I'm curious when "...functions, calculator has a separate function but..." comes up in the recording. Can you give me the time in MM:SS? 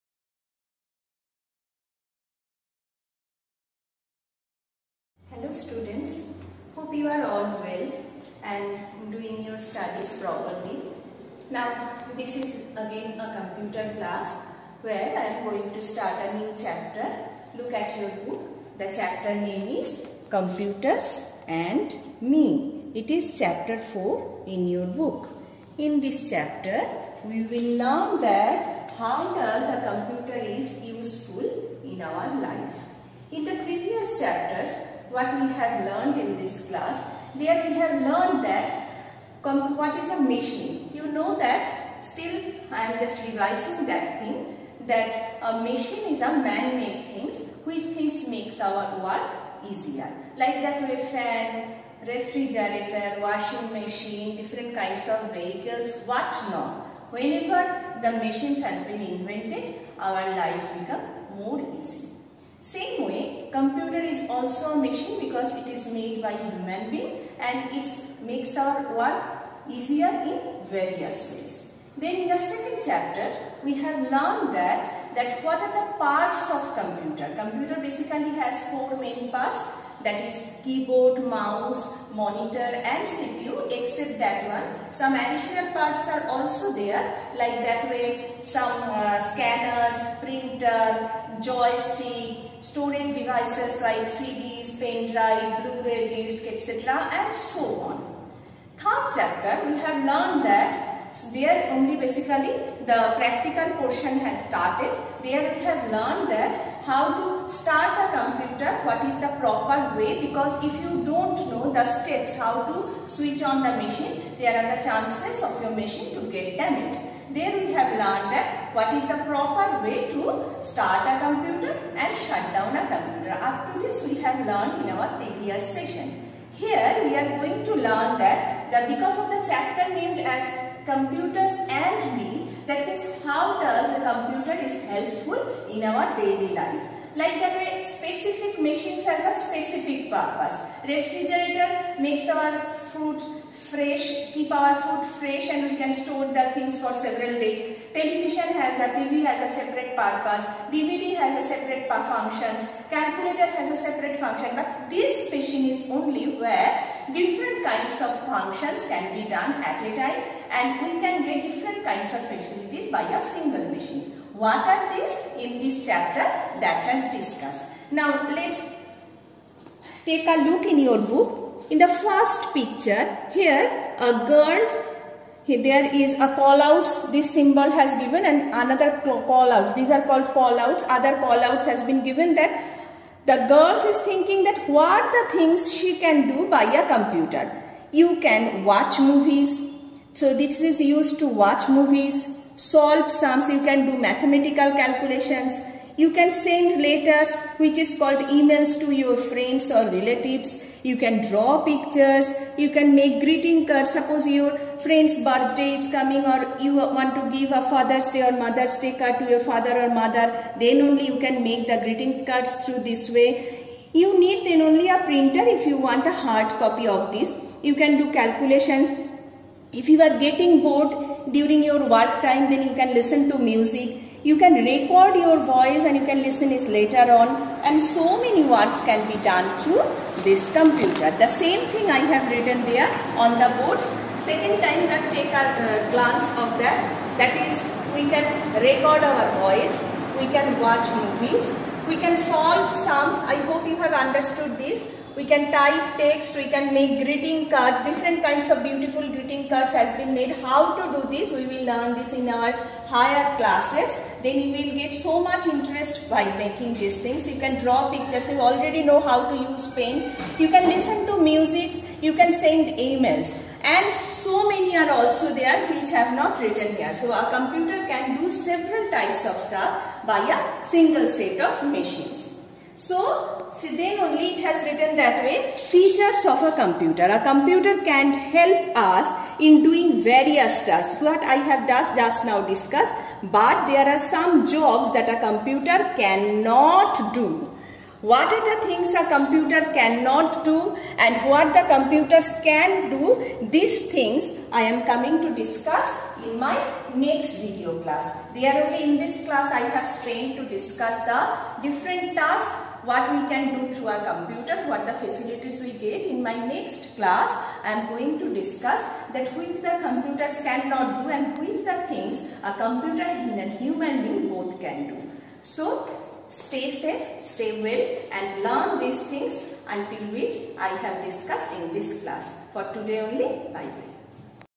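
02:31.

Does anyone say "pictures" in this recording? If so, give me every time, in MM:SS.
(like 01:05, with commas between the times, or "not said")
02:52, 03:21, 04:17.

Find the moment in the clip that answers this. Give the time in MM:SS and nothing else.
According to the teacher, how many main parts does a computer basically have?
01:18.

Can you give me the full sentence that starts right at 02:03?
Up to this we have learned in our previous session.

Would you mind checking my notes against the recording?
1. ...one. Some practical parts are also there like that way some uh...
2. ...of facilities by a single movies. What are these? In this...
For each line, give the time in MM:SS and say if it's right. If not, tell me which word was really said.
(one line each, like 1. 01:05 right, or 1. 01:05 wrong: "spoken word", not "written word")
1. 01:24 wrong: "additional", not "practical"
2. 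02:42 wrong: "machines", not "movies".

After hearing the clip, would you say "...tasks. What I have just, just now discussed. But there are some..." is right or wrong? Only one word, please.
right.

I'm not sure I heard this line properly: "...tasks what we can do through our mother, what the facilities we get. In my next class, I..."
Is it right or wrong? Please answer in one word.
wrong.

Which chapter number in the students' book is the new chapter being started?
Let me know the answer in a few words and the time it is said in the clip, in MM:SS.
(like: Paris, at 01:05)
4, at 00:23.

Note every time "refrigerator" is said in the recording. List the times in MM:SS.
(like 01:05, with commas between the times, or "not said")
00:52, 02:20.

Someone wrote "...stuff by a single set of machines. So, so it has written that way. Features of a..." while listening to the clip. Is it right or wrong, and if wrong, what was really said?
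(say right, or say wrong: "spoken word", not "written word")
right.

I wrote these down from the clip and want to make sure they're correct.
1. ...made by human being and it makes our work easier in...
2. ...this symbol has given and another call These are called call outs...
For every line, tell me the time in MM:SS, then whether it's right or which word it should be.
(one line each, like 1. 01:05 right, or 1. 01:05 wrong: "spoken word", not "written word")
1. 01:05 right
2. 02:57 right.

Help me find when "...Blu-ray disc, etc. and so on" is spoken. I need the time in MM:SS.
01:35.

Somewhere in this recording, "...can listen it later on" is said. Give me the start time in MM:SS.
03:46.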